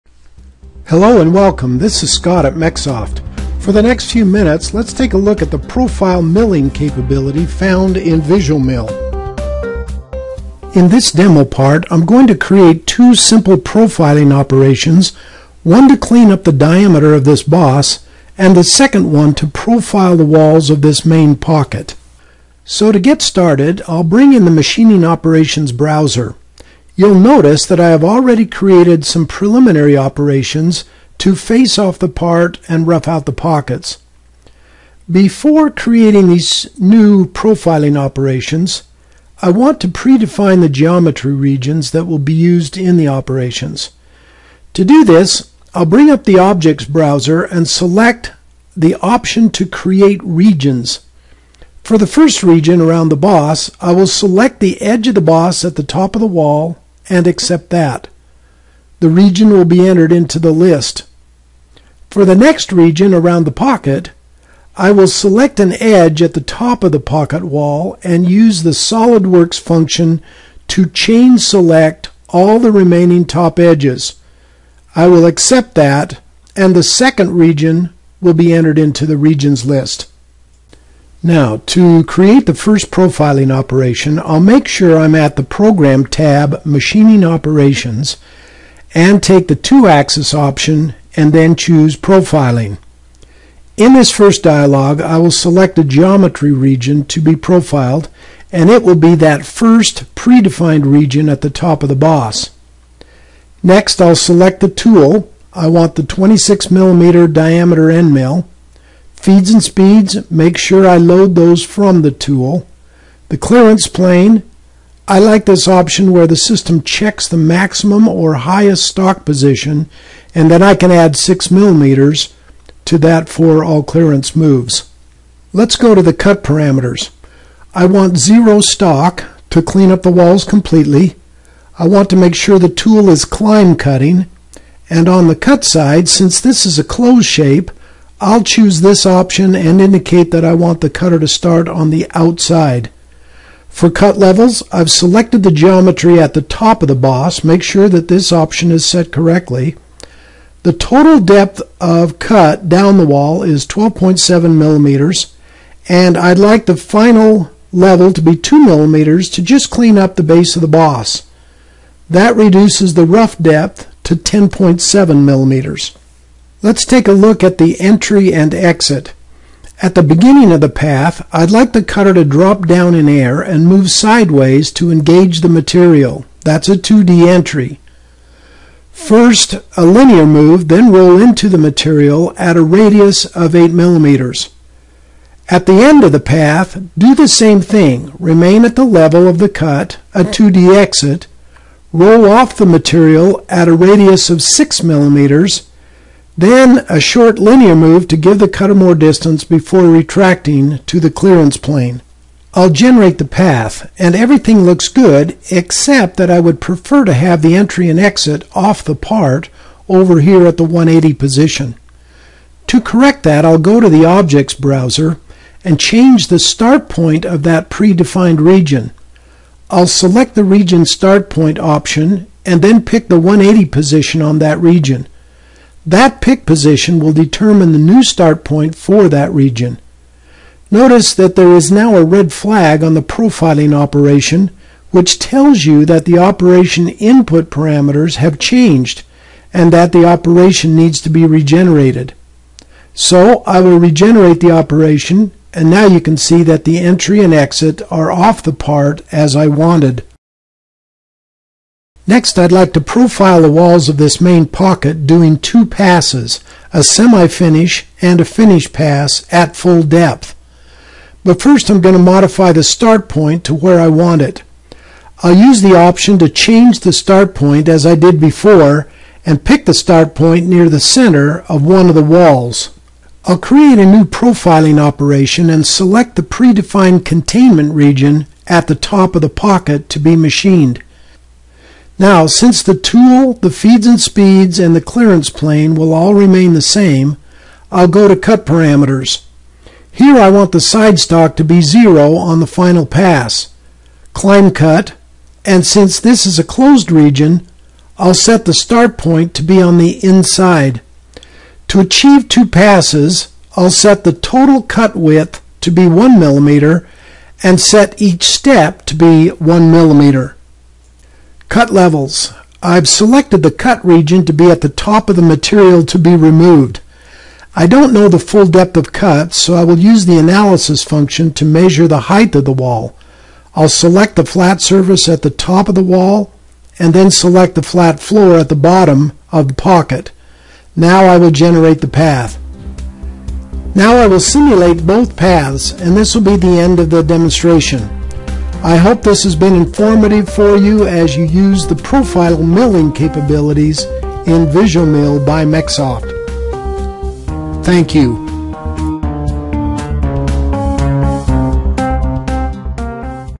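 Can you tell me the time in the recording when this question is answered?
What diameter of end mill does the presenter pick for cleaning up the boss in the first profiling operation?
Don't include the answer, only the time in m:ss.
1:46.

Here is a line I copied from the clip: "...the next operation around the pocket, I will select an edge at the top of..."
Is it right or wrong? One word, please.
wrong.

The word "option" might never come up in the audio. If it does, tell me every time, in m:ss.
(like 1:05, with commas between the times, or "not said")
0:48, 1:30, 1:55, 2:19, 2:28, 3:41, 4:25.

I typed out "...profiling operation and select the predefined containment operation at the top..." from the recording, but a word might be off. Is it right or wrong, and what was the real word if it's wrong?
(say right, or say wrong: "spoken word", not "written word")
wrong: "region", not "operation".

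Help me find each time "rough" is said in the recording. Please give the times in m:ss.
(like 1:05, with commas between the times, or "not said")
0:32, 2:43.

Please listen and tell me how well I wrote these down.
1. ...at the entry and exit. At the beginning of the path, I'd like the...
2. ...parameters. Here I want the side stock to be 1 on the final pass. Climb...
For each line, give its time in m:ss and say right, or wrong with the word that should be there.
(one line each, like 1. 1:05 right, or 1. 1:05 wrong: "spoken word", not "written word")
1. 2:47 right
2. 4:48 wrong: "0", not "1".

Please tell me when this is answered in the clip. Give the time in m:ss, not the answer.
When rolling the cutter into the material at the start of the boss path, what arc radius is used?
3:03.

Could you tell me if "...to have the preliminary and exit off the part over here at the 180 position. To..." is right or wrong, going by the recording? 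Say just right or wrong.
wrong.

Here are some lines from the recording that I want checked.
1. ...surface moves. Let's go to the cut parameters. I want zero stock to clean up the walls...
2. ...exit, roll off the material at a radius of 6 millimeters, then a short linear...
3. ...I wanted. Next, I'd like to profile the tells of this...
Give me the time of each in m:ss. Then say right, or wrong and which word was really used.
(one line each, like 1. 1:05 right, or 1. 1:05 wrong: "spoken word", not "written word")
1. 2:03 wrong: "clearance", not "surface"
2. 3:10 right
3. 4:09 wrong: "walls", not "tells".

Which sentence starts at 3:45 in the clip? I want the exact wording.
That pick position will determine the new start point for that region.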